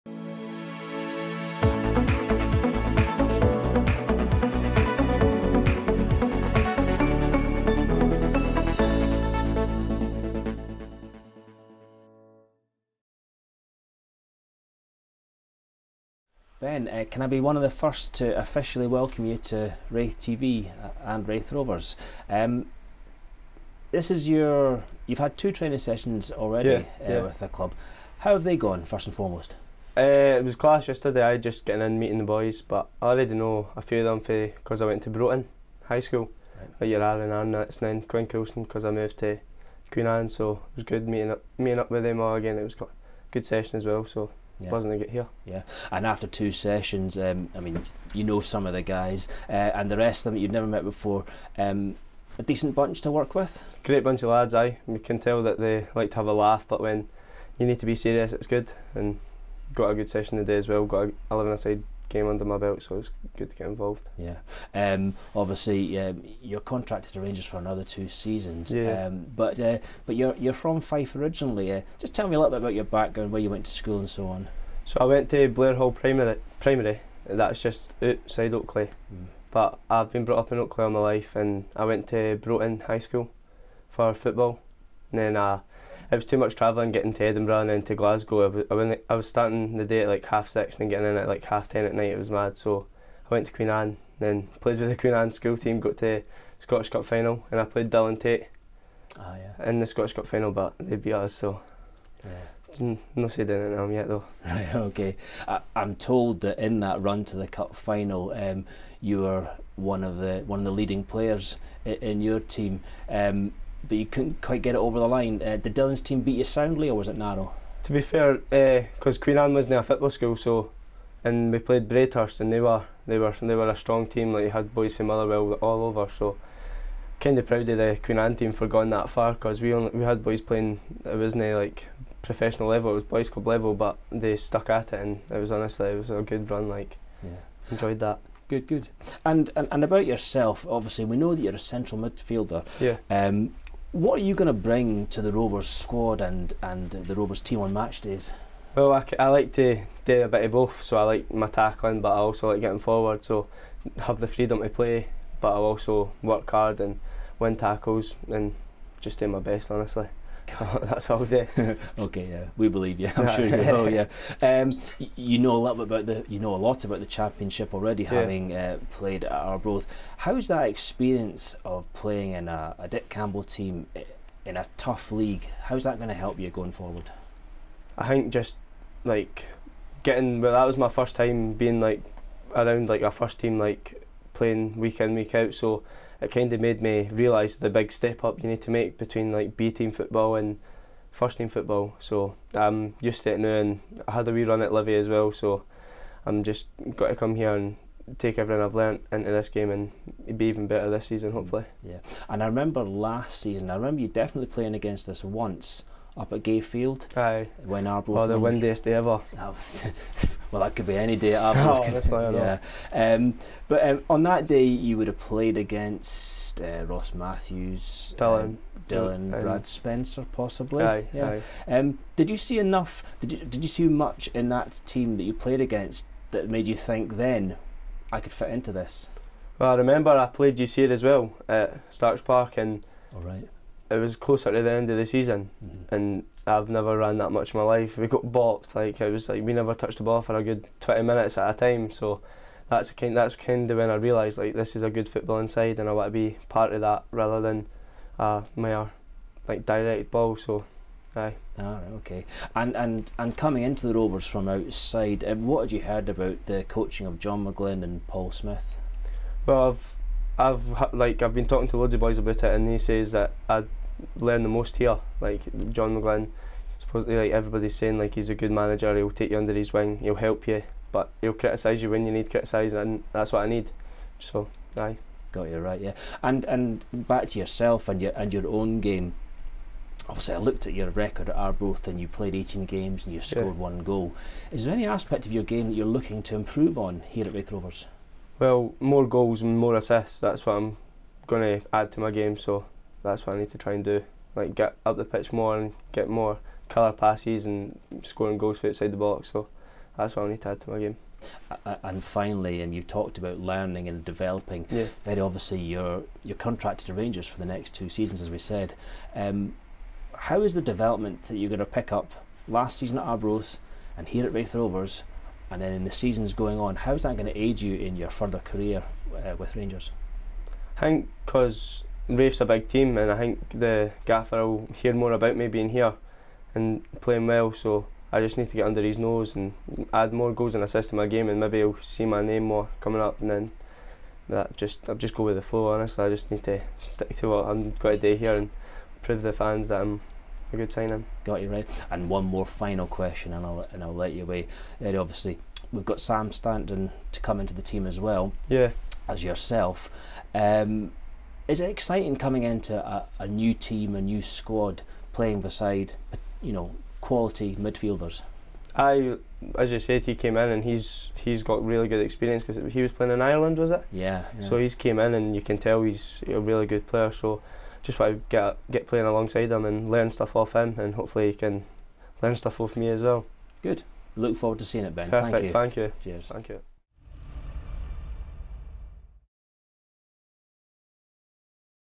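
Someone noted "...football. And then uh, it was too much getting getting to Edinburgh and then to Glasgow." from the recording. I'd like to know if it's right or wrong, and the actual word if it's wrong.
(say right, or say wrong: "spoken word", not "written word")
wrong: "travelling", not "getting".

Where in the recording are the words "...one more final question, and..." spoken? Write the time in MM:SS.
05:42.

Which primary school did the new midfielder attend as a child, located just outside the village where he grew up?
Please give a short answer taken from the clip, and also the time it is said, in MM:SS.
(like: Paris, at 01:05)
Blairhall Primary, at 01:15.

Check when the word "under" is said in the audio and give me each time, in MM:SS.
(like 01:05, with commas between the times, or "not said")
01:02, 04:29, 05:28.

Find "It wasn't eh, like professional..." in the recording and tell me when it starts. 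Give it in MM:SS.
02:11.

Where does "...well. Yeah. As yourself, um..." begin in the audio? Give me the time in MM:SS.
05:47.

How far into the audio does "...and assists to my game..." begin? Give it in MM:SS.
05:30.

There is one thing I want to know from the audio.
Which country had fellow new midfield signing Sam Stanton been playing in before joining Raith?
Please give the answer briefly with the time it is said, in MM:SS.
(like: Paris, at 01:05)
Ireland, at 06:03.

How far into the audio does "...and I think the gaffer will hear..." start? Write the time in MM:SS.
05:22.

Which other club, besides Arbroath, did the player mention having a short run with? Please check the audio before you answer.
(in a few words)
Livy.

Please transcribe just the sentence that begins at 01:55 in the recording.
Uh, did Dylan's team beat you soundly, or was it narrow?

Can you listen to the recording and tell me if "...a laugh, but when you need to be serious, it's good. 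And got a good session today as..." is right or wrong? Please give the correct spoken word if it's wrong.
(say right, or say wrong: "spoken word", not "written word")
right.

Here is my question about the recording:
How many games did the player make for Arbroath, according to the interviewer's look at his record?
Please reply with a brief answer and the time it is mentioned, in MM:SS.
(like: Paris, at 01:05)
18, at 04:42.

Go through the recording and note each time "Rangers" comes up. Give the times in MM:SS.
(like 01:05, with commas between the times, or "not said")
01:07, 05:06, 05:19.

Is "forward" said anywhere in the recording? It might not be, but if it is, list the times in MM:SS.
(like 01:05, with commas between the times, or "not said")
02:32, 02:56, 06:14.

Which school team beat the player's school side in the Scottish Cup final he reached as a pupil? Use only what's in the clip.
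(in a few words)
Braidhurst.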